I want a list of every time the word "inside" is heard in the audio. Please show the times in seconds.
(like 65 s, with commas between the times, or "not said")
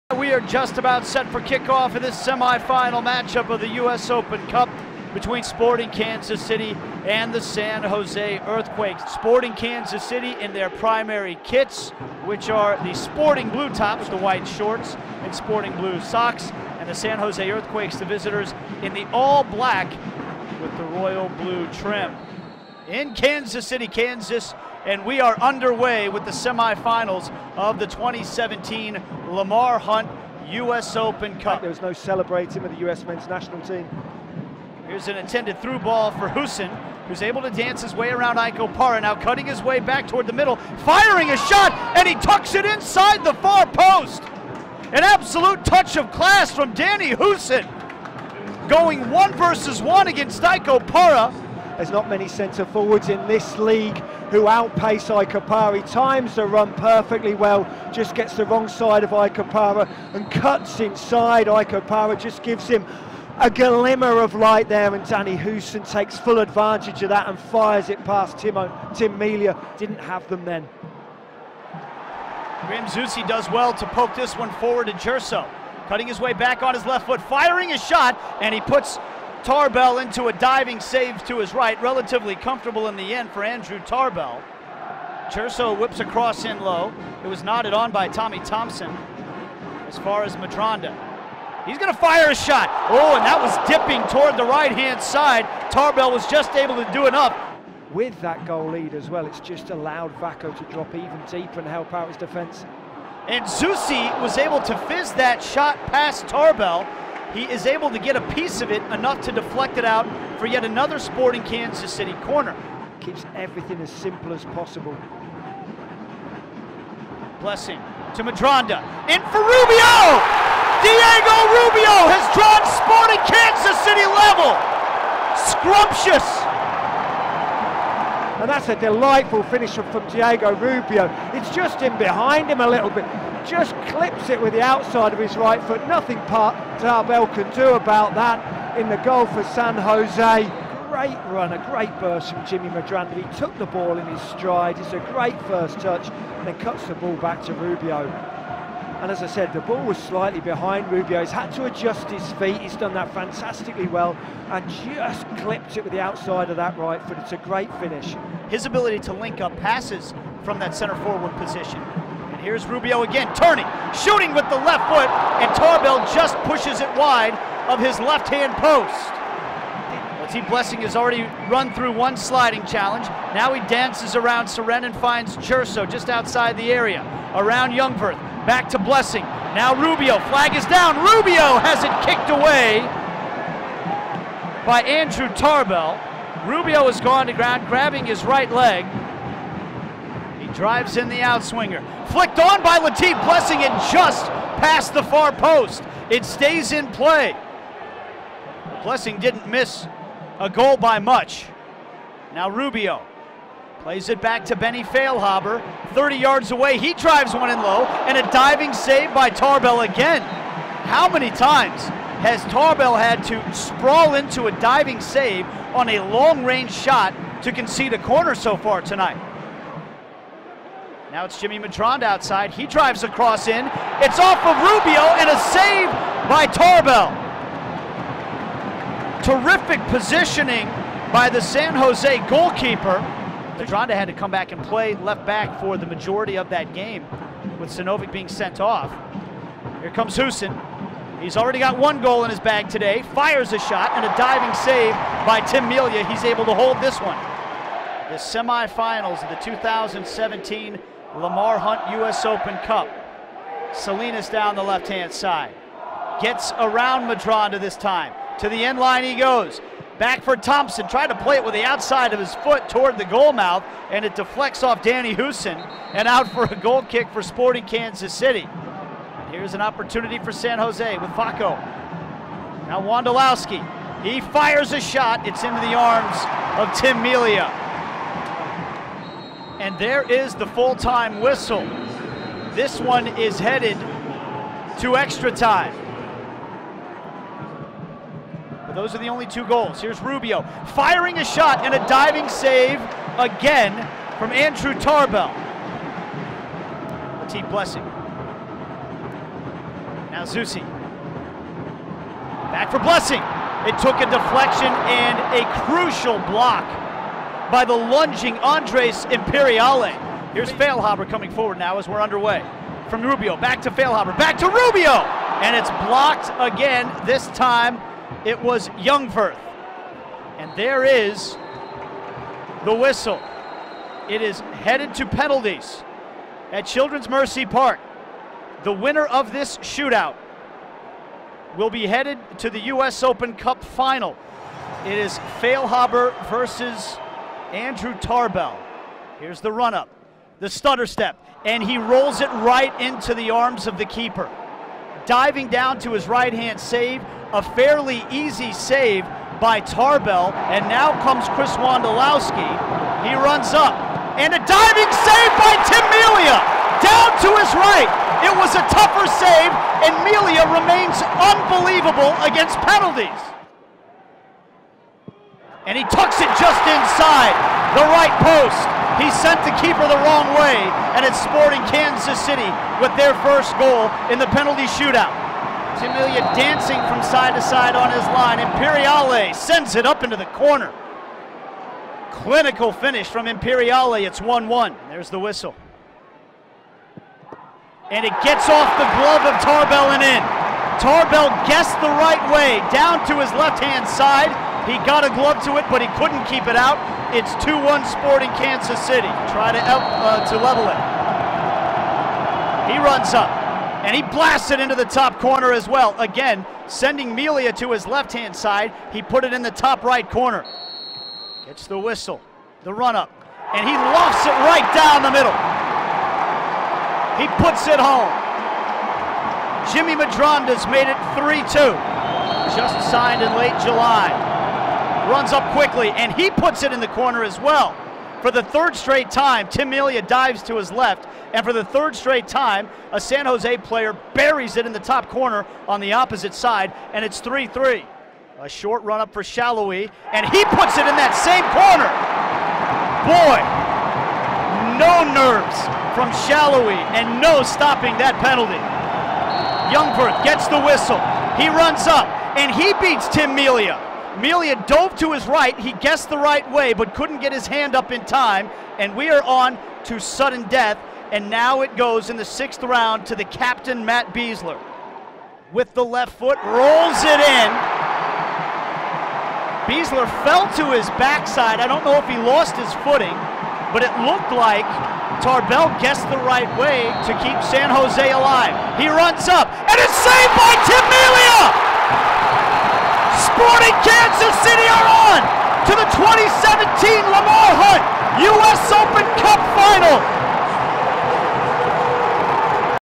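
42 s, 60 s, 366 s.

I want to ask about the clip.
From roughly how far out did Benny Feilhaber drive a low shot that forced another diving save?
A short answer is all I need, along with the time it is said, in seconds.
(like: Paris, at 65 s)
30 yards, at 205 s.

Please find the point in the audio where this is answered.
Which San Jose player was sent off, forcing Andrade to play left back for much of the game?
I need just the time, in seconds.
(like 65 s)
237 s.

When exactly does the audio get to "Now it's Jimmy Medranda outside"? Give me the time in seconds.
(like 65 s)
221 s.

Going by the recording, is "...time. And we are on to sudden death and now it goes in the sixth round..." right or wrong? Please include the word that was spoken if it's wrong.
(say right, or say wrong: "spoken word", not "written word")
right.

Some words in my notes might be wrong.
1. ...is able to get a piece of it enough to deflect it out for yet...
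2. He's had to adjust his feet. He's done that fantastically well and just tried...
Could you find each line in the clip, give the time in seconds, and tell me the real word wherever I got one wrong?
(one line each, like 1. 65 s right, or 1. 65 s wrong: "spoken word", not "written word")
1. 107 s right
2. 151 s wrong: "clipped", not "tried".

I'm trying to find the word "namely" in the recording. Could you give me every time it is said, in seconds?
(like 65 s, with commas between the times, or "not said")
not said.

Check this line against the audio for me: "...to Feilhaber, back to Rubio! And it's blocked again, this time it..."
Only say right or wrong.
right.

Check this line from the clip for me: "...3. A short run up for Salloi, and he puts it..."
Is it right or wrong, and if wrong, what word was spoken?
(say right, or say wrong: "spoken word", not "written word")
right.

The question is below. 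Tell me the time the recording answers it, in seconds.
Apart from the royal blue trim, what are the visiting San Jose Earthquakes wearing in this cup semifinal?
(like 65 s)
19 s.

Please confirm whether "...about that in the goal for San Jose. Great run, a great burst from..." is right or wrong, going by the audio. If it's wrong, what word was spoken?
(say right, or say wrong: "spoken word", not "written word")
right.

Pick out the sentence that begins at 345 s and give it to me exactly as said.
Diving down to his right-hand save, a fairly easy save by Tarbell.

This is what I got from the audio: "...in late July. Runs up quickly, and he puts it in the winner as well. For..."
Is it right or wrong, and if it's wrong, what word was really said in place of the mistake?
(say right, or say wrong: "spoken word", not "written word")
wrong: "corner", not "winner".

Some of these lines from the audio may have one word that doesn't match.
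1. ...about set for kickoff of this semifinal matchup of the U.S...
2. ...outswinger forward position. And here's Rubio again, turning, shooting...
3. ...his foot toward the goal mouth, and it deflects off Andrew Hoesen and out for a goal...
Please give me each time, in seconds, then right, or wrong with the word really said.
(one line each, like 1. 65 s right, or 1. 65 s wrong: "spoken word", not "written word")
1. 0 s right
2. 160 s wrong: "center", not "outswinger"
3. 262 s wrong: "Danny", not "Andrew".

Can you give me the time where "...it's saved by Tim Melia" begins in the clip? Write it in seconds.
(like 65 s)
479 s.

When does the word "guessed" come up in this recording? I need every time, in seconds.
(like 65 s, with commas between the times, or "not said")
391 s, 455 s, 475 s.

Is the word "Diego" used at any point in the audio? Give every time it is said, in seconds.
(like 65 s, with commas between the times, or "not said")
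120 s, 130 s.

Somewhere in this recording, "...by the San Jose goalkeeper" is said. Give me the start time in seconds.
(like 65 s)
231 s.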